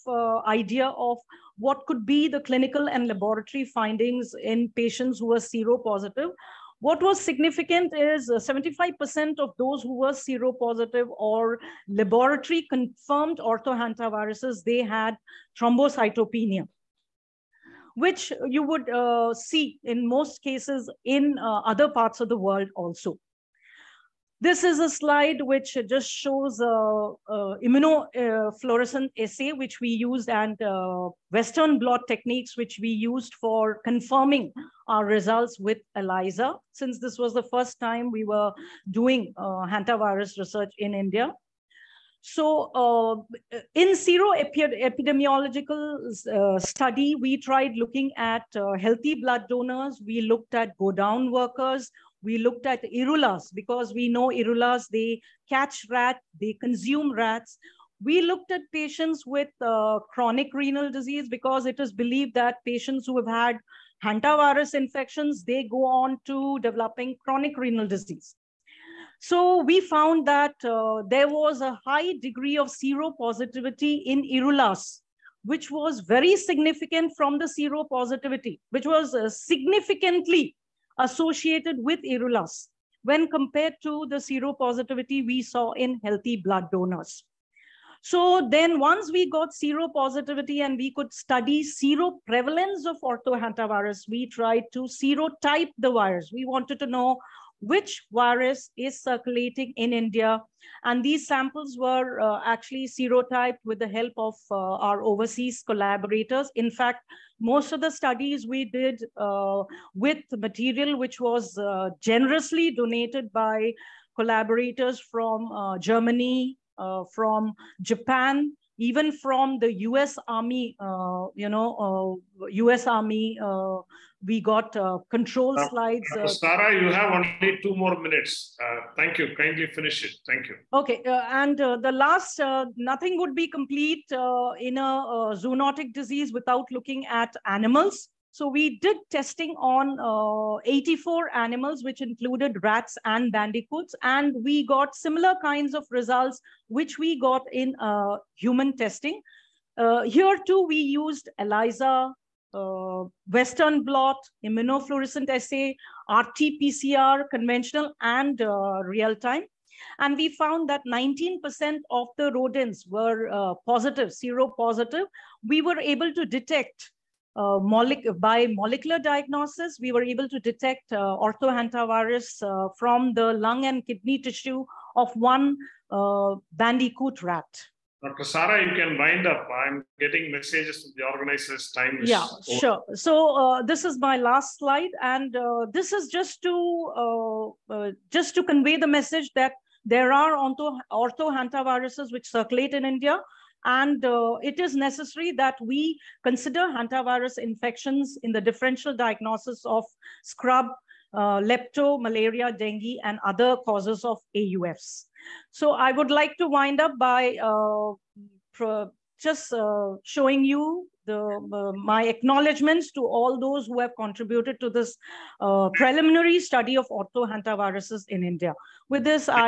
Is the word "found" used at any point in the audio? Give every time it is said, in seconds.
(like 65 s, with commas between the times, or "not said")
69 s, 160 s.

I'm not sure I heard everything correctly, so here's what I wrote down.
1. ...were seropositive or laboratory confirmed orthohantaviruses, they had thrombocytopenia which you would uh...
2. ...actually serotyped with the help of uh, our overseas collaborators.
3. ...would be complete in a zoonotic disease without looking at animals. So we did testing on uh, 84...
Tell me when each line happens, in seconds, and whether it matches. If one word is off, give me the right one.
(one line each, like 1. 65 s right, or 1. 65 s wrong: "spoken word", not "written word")
1. 9 s right
2. 102 s right
3. 133 s right.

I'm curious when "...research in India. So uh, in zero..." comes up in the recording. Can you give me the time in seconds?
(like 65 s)
40 s.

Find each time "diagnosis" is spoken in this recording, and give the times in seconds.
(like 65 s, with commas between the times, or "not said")
168 s, 198 s.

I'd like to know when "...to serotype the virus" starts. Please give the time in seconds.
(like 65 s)
94 s.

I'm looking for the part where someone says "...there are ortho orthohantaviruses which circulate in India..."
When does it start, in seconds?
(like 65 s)
189 s.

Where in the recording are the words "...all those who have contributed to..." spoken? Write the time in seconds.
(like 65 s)
213 s.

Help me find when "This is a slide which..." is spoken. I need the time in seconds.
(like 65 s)
24 s.